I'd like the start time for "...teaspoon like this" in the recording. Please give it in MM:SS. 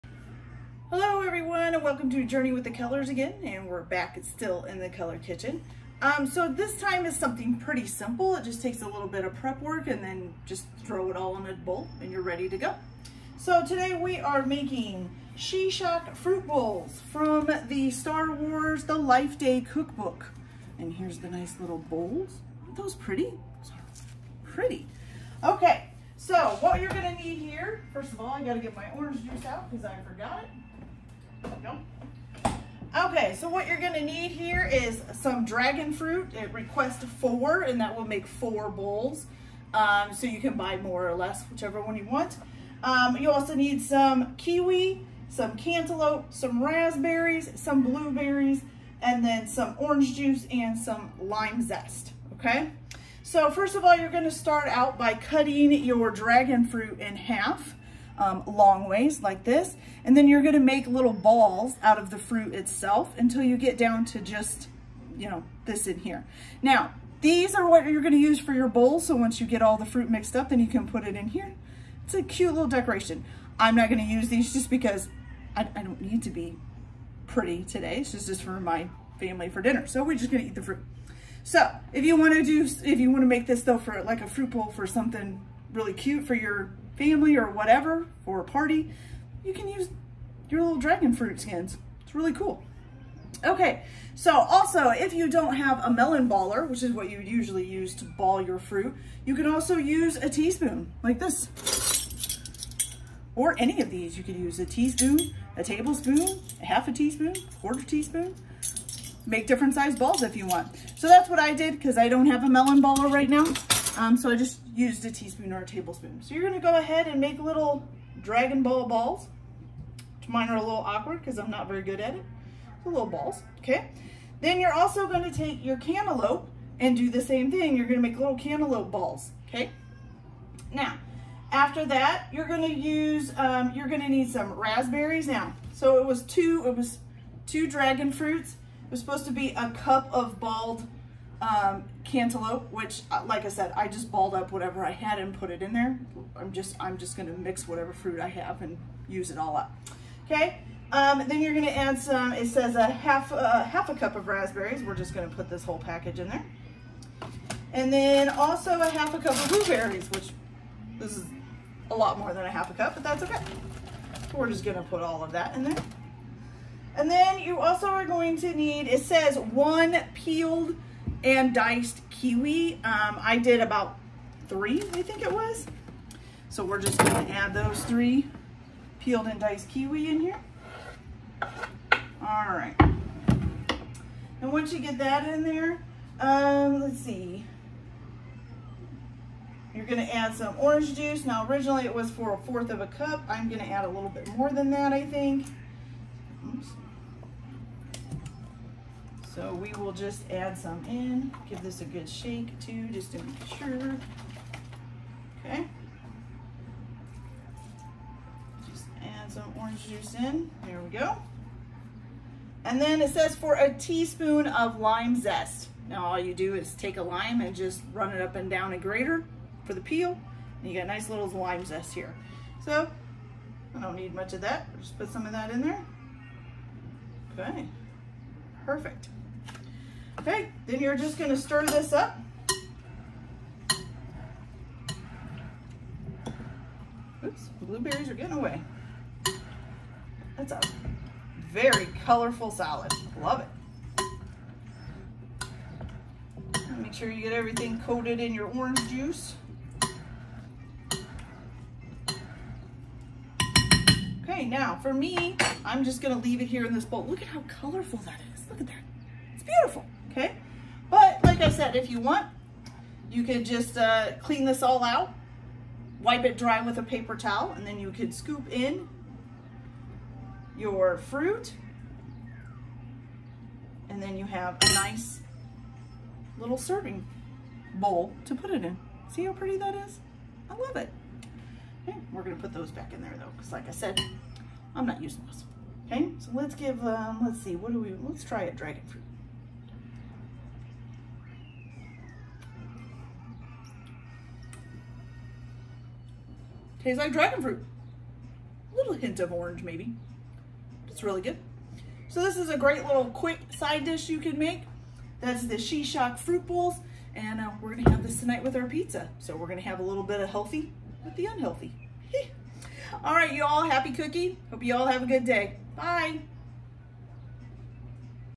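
01:40.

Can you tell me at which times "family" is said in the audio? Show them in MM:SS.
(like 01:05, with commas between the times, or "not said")
01:19, 01:26.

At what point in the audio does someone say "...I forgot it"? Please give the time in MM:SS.
00:29.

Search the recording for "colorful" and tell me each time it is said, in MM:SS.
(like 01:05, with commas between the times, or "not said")
04:02, 04:17.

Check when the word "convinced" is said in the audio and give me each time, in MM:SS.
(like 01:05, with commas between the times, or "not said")
not said.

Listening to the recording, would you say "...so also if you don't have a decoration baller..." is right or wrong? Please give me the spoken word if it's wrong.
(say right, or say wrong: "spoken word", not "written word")
wrong: "melon", not "decoration".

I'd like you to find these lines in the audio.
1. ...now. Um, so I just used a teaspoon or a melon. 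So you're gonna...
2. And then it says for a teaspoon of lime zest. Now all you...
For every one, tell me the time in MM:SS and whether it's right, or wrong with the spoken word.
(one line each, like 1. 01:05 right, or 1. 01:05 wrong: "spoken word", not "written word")
1. 01:53 wrong: "tablespoon", not "melon"
2. 03:32 right.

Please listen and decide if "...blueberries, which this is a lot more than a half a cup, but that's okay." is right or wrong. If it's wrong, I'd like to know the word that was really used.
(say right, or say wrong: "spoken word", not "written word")
right.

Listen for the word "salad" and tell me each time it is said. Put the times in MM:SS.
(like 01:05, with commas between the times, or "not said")
04:02.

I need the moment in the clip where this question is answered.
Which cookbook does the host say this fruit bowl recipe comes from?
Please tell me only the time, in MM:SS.
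00:17.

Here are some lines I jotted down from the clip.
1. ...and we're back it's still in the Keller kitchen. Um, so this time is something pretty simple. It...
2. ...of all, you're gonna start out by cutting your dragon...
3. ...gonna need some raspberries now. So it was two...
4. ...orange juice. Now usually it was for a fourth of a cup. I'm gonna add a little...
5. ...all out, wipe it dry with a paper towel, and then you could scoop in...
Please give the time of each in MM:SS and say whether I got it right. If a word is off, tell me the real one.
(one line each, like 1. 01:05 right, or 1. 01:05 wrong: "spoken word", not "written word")
1. 00:03 right
2. 00:53 right
3. 02:13 right
4. 03:10 wrong: "originally", not "usually"
5. 04:24 right.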